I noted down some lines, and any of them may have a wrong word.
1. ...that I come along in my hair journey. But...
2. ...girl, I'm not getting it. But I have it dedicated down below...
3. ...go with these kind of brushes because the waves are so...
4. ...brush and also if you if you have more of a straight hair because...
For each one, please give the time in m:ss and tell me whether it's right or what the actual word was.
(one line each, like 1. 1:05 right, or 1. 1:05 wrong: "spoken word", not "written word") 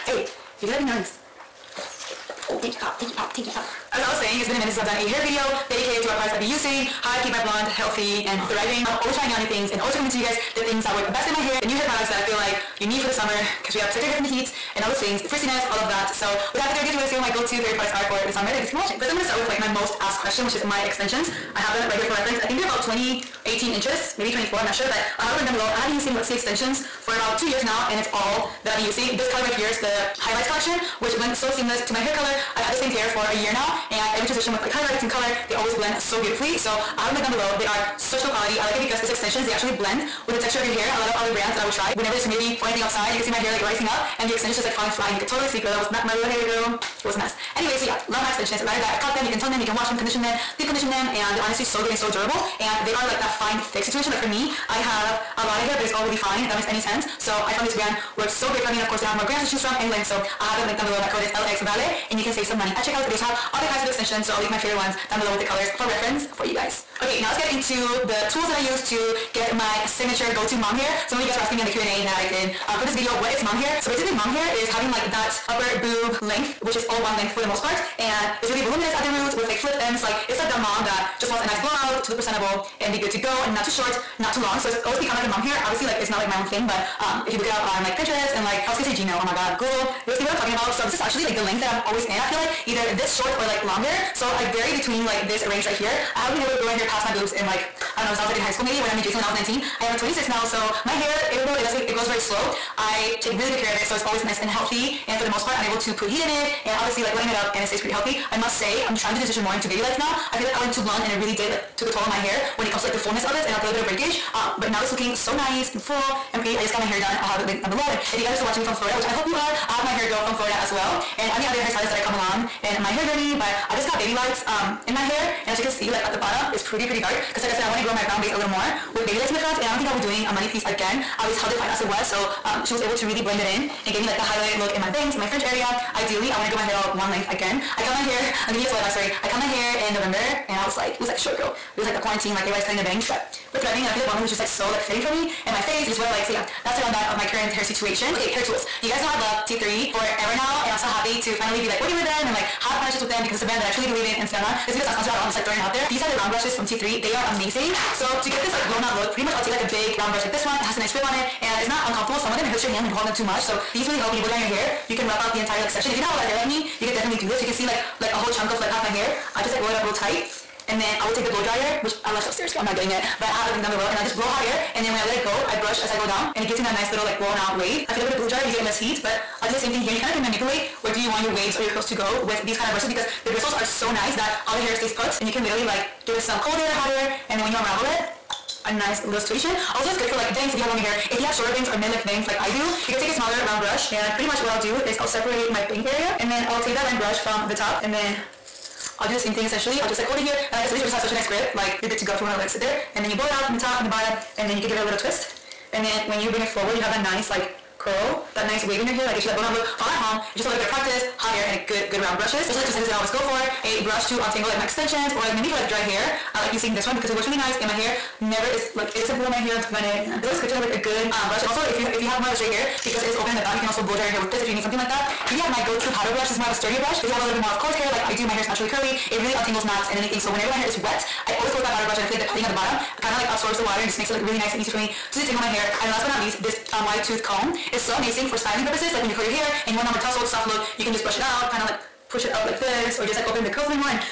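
1. 2:01 right
2. 2:52 wrong: "linked", not "dedicated"
3. 3:01 wrong: "bristles", not "waves"
4. 3:41 right.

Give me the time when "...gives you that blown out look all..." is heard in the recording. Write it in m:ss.
3:29.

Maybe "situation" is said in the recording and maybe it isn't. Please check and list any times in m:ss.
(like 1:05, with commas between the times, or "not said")
0:53, 2:27, 3:09.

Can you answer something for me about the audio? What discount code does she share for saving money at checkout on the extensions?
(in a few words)
vale.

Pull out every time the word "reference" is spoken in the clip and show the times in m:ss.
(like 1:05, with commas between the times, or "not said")
0:22, 1:05.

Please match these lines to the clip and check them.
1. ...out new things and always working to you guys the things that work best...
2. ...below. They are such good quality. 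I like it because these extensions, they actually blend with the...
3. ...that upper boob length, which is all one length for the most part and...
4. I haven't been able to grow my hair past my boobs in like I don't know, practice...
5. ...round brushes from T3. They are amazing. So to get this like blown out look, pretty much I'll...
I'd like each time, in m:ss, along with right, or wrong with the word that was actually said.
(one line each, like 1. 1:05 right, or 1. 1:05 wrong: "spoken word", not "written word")
1. 0:09 wrong: "recommending", not "working"
2. 0:37 right
3. 1:15 right
4. 1:36 wrong: "since", not "practice"
5. 2:36 right.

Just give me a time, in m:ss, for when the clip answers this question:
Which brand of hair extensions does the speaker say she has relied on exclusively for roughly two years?
0:26.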